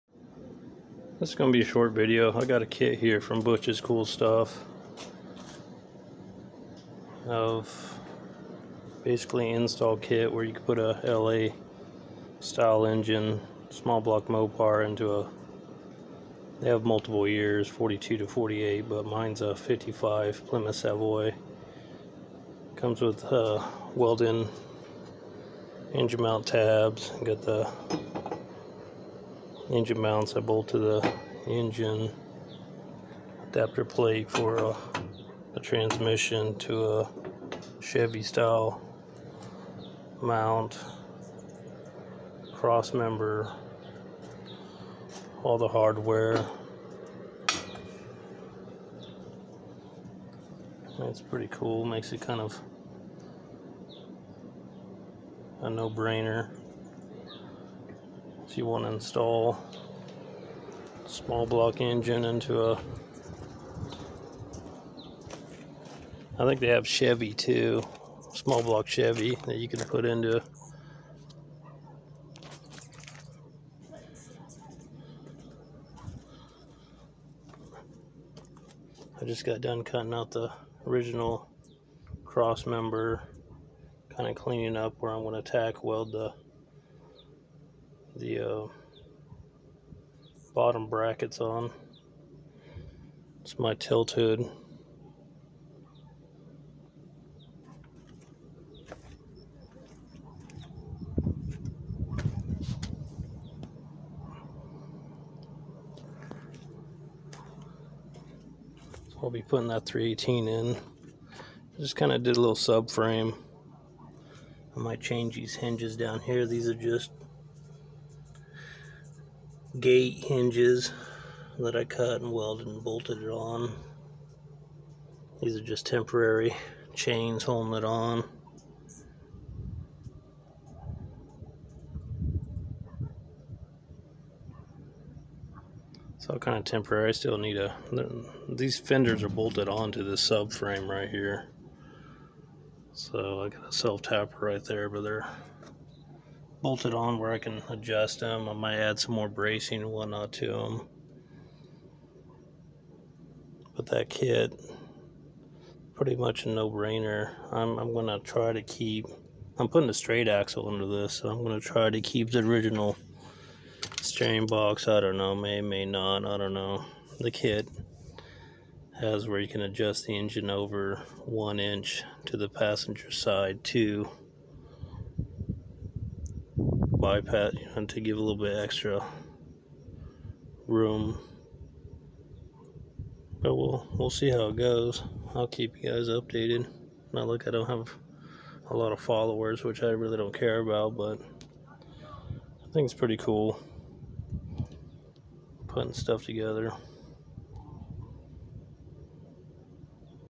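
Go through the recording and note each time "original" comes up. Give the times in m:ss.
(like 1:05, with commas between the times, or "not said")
1:20, 2:42.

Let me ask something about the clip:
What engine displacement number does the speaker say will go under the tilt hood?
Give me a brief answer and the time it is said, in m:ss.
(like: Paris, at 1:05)
318, at 1:49.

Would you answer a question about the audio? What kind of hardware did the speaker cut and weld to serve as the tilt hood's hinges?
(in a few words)
Gate hinges.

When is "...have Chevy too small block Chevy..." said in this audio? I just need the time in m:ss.
1:06.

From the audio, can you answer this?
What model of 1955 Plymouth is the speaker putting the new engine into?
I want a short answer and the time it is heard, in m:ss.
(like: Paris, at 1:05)
Savoy, at 0:20.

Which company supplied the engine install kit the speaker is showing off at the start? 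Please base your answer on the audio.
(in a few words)
Butch's Cool Stuff.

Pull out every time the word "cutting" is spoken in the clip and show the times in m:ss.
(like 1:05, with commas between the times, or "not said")
1:19.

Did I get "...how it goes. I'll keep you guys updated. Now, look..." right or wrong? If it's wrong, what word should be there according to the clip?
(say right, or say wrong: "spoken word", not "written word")
right.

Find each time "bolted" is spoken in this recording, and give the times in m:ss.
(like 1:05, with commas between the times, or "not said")
0:30, 2:02, 2:19, 2:26.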